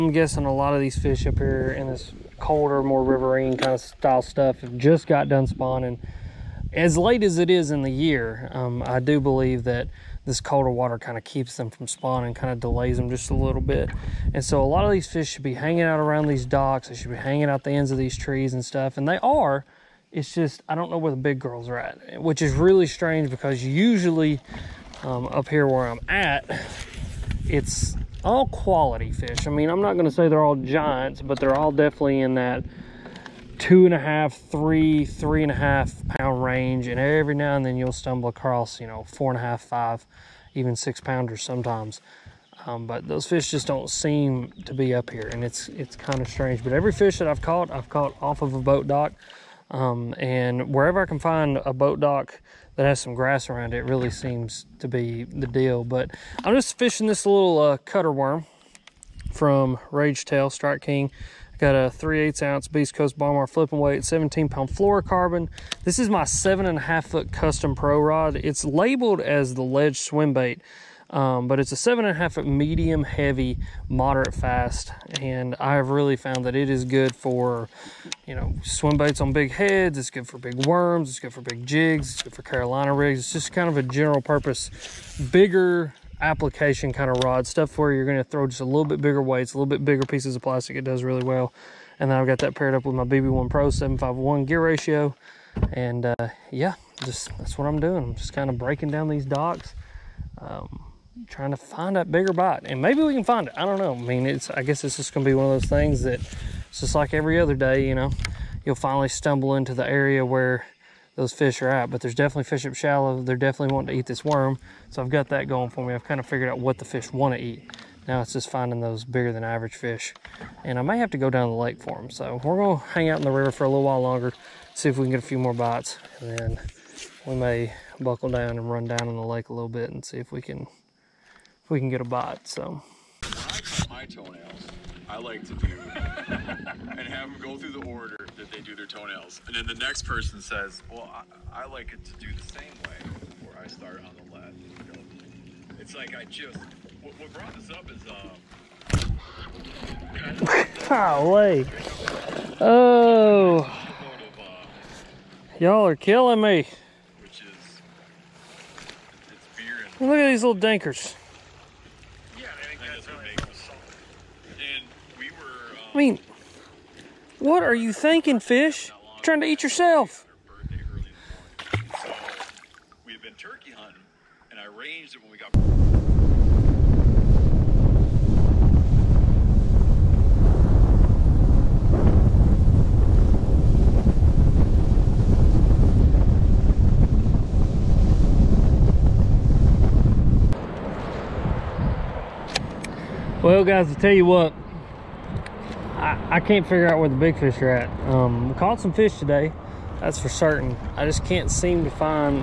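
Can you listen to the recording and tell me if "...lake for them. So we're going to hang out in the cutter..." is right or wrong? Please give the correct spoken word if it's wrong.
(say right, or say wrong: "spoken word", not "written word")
wrong: "river", not "cutter".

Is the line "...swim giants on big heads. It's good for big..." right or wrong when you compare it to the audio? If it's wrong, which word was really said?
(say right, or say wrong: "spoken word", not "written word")
wrong: "baits", not "giants".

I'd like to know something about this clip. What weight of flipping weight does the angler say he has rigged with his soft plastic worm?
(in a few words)
3/8 ounce.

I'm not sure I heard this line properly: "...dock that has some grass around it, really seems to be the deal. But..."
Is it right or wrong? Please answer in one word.
right.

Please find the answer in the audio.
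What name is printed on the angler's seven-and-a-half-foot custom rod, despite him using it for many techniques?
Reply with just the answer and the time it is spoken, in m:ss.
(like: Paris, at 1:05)
Ledge Swim Bait, at 1:09.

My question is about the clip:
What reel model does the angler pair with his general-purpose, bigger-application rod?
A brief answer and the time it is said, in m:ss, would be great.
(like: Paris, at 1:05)
BB1 Pro, at 1:33.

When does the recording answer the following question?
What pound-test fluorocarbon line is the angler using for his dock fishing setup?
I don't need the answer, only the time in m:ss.
1:04.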